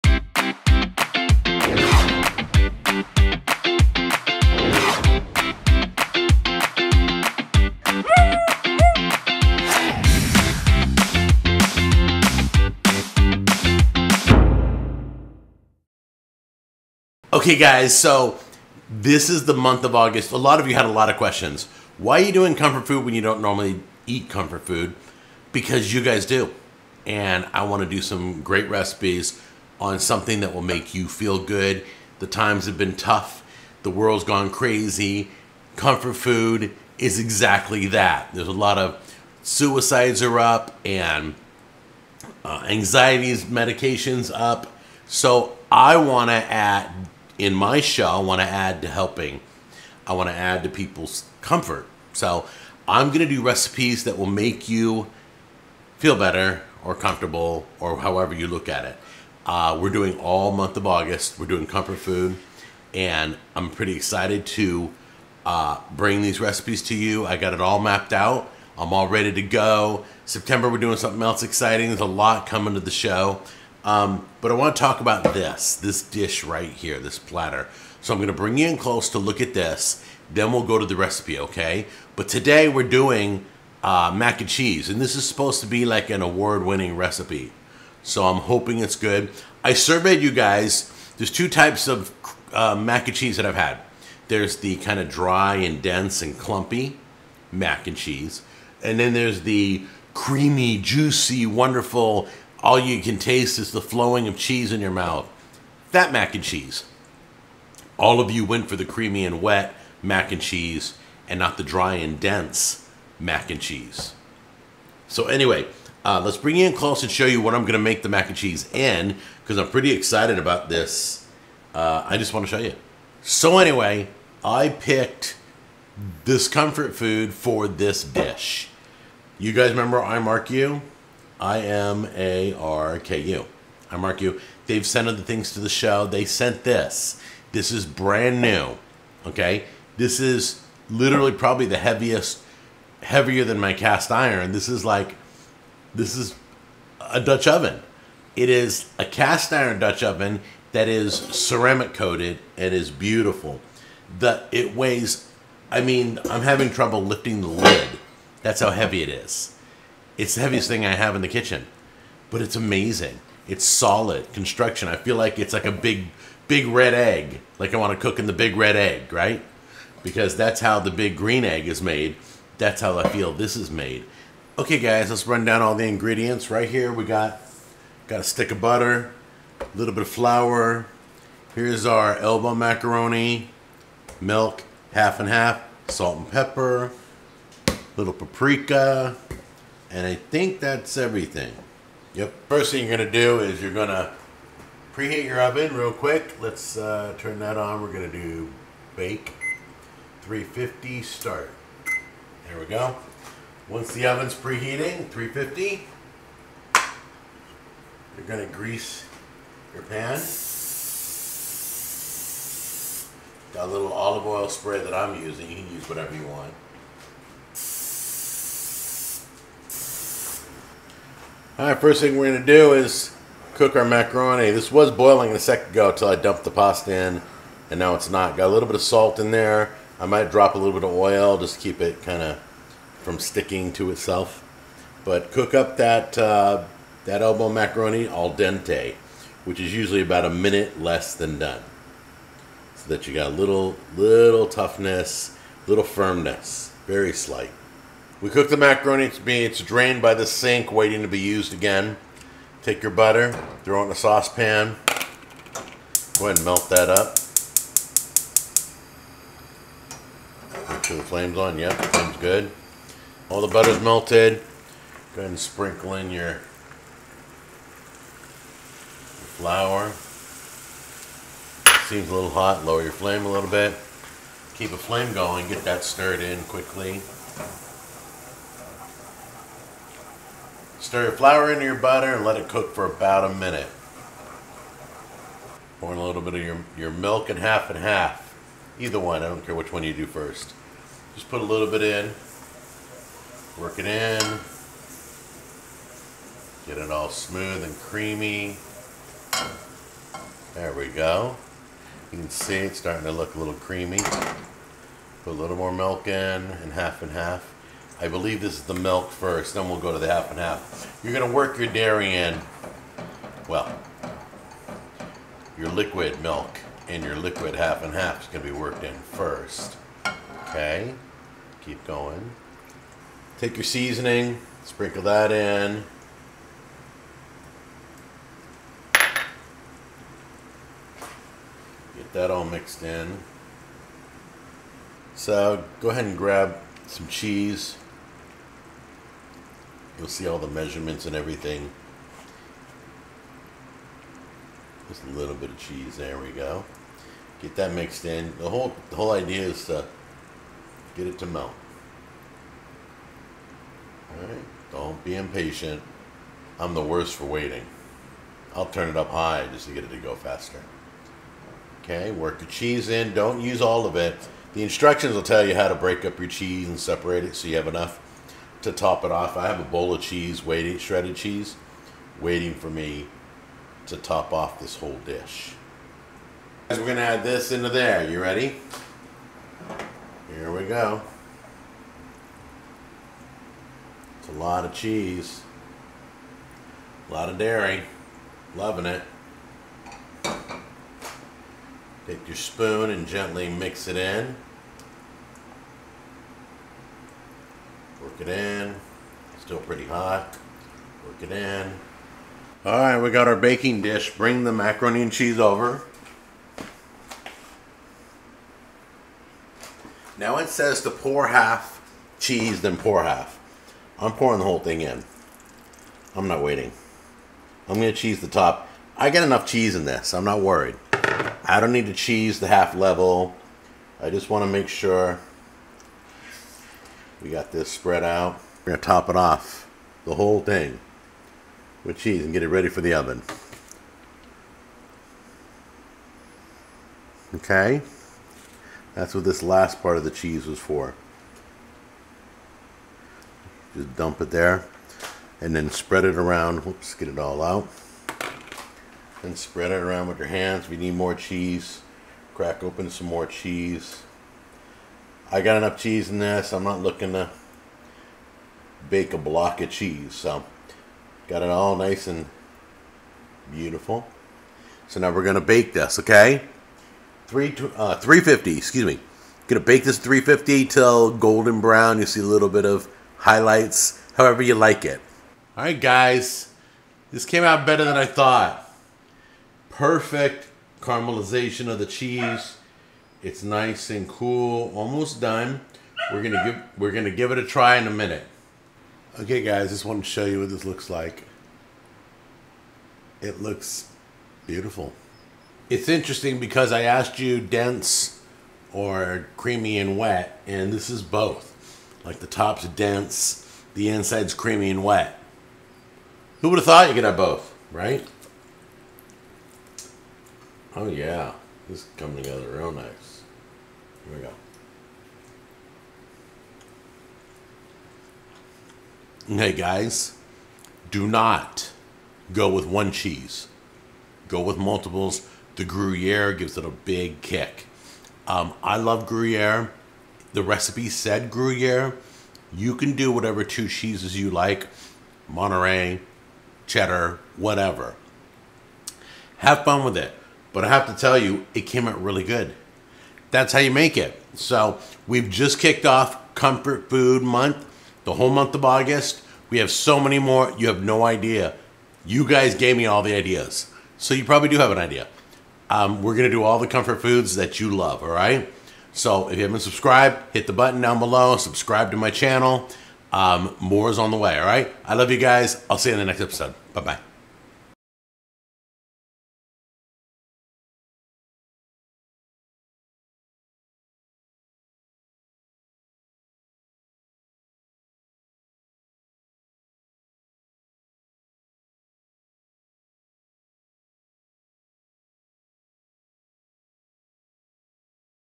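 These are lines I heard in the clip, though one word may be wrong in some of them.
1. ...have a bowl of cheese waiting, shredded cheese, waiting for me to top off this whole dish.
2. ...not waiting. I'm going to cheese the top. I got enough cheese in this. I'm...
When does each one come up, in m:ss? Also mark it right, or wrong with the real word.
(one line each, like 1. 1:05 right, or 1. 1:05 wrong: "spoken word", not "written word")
1. 6:09 right
2. 6:56 right.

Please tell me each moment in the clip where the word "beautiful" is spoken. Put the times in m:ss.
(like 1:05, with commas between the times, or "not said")
2:32, 7:43, 8:14.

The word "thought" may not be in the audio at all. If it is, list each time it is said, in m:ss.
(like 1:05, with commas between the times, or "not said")
7:58, 8:26.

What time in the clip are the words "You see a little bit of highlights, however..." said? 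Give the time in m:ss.
7:51.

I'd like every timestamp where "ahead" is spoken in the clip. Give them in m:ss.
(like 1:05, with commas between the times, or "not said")
4:16, 4:25, 5:35.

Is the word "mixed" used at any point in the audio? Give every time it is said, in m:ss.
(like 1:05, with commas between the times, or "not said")
5:32, 5:47.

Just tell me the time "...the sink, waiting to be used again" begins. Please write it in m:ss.
4:10.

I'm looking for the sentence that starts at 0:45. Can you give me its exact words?
So I want to add in my show, I want to add to helping.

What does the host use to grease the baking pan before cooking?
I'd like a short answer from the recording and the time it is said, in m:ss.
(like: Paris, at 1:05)
olive oil spray, at 3:33.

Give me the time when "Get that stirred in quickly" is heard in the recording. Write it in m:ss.
4:35.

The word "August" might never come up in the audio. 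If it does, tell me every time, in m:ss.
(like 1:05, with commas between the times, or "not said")
0:19, 1:00, 9:08.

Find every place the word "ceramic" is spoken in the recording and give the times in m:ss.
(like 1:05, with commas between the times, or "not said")
2:31.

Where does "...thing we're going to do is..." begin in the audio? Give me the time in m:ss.
3:42.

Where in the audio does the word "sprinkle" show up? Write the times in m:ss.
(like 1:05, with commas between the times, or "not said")
4:25, 5:24.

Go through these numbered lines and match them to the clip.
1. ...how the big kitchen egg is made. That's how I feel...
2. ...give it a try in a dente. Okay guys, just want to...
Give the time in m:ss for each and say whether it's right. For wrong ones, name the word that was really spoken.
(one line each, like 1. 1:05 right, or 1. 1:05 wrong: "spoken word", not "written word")
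1. 2:50 wrong: "green", not "kitchen"
2. 8:07 wrong: "minute", not "dente".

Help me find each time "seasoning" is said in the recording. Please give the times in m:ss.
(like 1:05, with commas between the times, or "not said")
5:23.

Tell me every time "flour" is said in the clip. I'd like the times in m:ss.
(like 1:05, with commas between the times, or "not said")
3:00, 4:29, 4:41.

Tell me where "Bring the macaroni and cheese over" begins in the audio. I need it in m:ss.
6:44.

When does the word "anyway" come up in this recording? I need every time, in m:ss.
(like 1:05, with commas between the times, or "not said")
1:55, 2:03.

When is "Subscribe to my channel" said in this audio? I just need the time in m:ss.
9:21.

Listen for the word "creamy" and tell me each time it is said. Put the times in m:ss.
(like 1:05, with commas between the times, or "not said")
1:40, 1:48, 4:57, 5:03, 8:19, 8:24.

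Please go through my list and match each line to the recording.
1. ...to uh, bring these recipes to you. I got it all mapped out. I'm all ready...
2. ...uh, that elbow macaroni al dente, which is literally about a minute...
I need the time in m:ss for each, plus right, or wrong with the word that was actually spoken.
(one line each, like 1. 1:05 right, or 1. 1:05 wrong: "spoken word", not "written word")
1. 1:04 right
2. 3:56 wrong: "usually", not "literally".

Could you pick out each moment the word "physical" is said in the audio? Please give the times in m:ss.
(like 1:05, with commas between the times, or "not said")
not said.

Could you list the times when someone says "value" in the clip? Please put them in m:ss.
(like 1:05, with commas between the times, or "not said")
not said.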